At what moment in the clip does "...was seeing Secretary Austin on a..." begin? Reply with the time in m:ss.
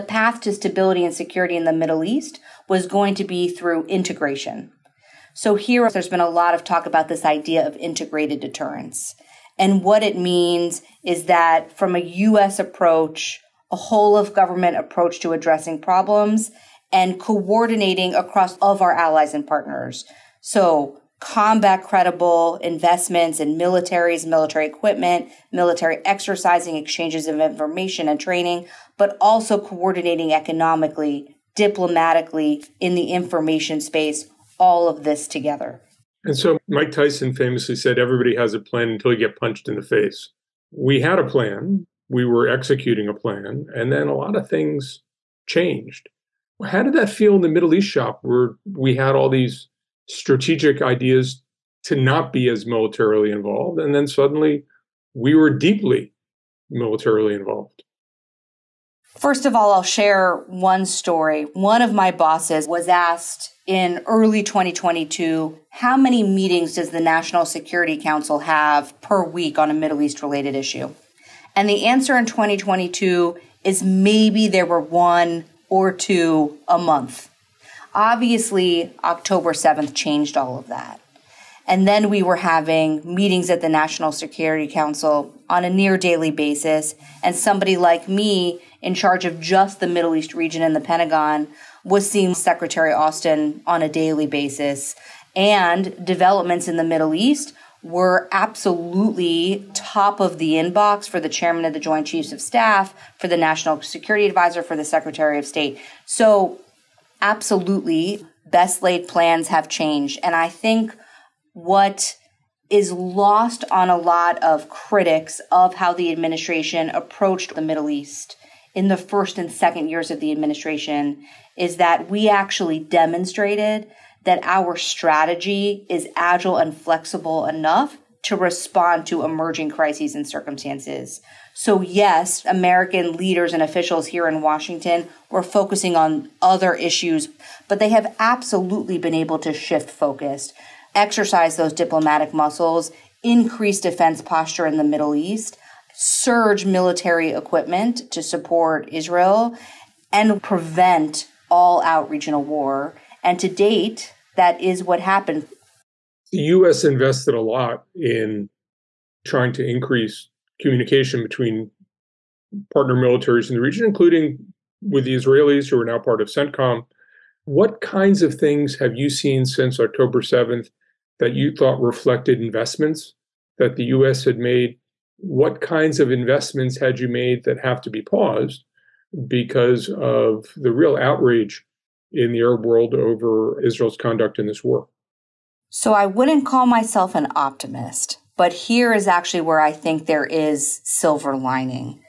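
1:31.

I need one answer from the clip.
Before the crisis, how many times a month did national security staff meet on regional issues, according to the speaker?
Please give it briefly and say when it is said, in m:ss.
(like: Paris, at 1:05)
1 or 2, at 1:14.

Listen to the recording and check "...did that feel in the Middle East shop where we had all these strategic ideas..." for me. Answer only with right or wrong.
right.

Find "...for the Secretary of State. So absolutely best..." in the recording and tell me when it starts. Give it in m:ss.
1:44.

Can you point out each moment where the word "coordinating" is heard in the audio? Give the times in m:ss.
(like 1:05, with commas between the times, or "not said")
0:17, 0:29.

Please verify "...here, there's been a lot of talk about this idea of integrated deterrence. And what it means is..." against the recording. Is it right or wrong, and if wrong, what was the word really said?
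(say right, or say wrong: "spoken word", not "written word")
right.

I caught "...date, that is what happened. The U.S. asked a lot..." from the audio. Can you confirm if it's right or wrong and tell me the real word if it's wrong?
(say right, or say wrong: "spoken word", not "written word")
wrong: "invested", not "asked".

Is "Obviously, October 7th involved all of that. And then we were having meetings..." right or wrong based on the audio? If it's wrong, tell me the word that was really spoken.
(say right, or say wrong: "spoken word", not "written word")
wrong: "changed", not "involved".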